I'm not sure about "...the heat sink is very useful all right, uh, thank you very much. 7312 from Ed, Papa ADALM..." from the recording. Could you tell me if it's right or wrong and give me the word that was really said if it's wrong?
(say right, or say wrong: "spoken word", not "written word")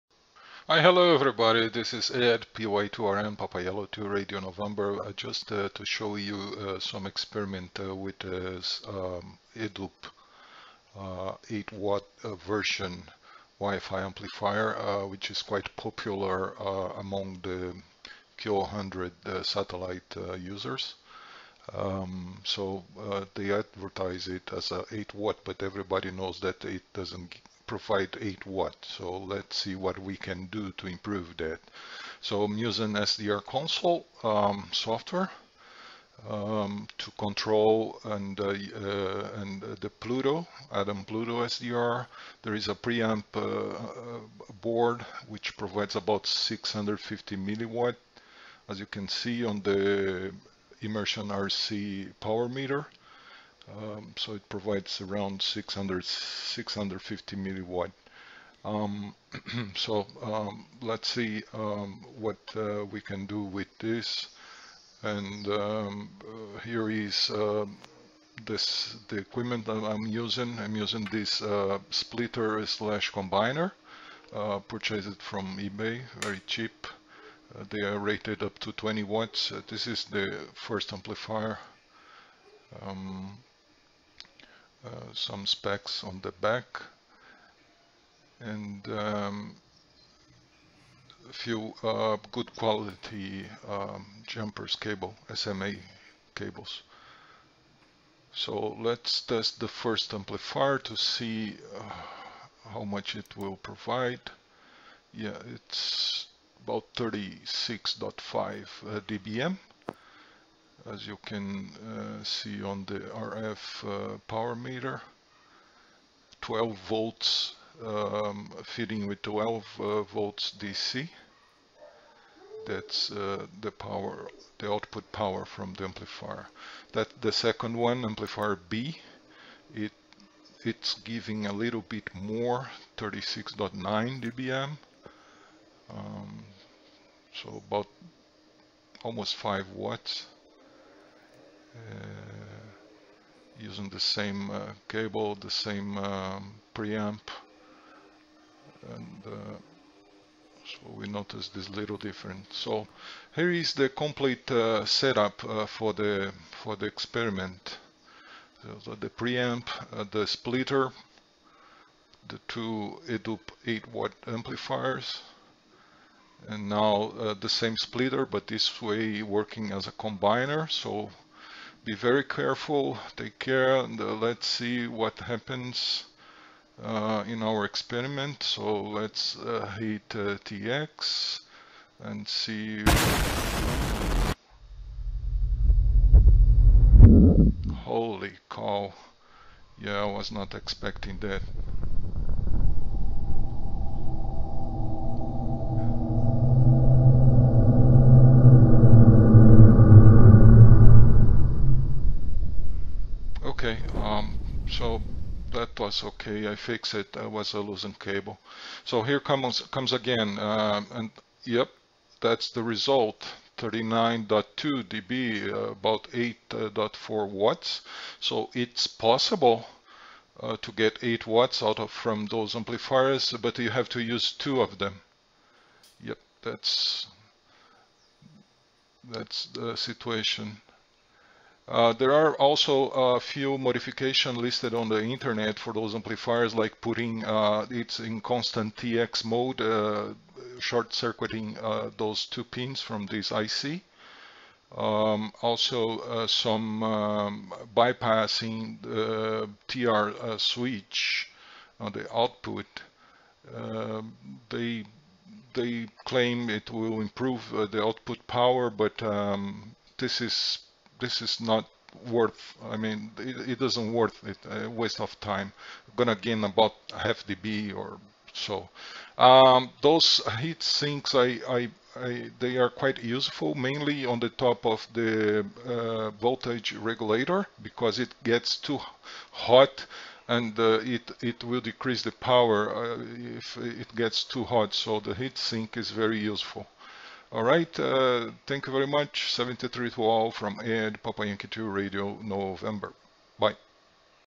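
wrong: "Yankee", not "ADALM".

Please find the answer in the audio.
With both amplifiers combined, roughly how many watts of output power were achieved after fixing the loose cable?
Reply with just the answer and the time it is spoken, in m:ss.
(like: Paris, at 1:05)
8.4 watts, at 3:36.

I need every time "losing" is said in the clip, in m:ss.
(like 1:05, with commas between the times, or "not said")
3:27.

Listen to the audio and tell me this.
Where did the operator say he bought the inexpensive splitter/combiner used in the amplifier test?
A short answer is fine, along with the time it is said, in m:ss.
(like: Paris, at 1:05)
eBay, at 1:15.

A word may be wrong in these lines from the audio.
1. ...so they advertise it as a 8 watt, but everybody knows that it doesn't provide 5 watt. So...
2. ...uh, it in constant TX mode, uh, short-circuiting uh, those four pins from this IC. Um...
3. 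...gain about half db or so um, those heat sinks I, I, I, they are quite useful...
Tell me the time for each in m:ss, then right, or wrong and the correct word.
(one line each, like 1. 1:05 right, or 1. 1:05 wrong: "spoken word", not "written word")
1. 0:22 wrong: "8", not "5"
2. 3:57 wrong: "two", not "four"
3. 4:26 right.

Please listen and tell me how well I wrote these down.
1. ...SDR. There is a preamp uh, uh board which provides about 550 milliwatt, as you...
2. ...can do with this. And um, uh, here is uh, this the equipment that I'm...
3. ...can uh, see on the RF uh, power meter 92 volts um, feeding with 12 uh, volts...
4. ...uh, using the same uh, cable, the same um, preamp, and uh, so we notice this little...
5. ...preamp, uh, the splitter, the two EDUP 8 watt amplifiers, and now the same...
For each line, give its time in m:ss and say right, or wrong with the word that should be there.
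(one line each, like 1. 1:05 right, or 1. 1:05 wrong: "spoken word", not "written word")
1. 0:41 wrong: "650", not "550"
2. 1:03 right
3. 1:51 wrong: "12", not "92"
4. 2:21 right
5. 2:39 right.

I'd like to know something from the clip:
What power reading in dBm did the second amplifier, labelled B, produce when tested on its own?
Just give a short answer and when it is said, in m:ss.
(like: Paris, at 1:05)
36.9 dBm, at 2:12.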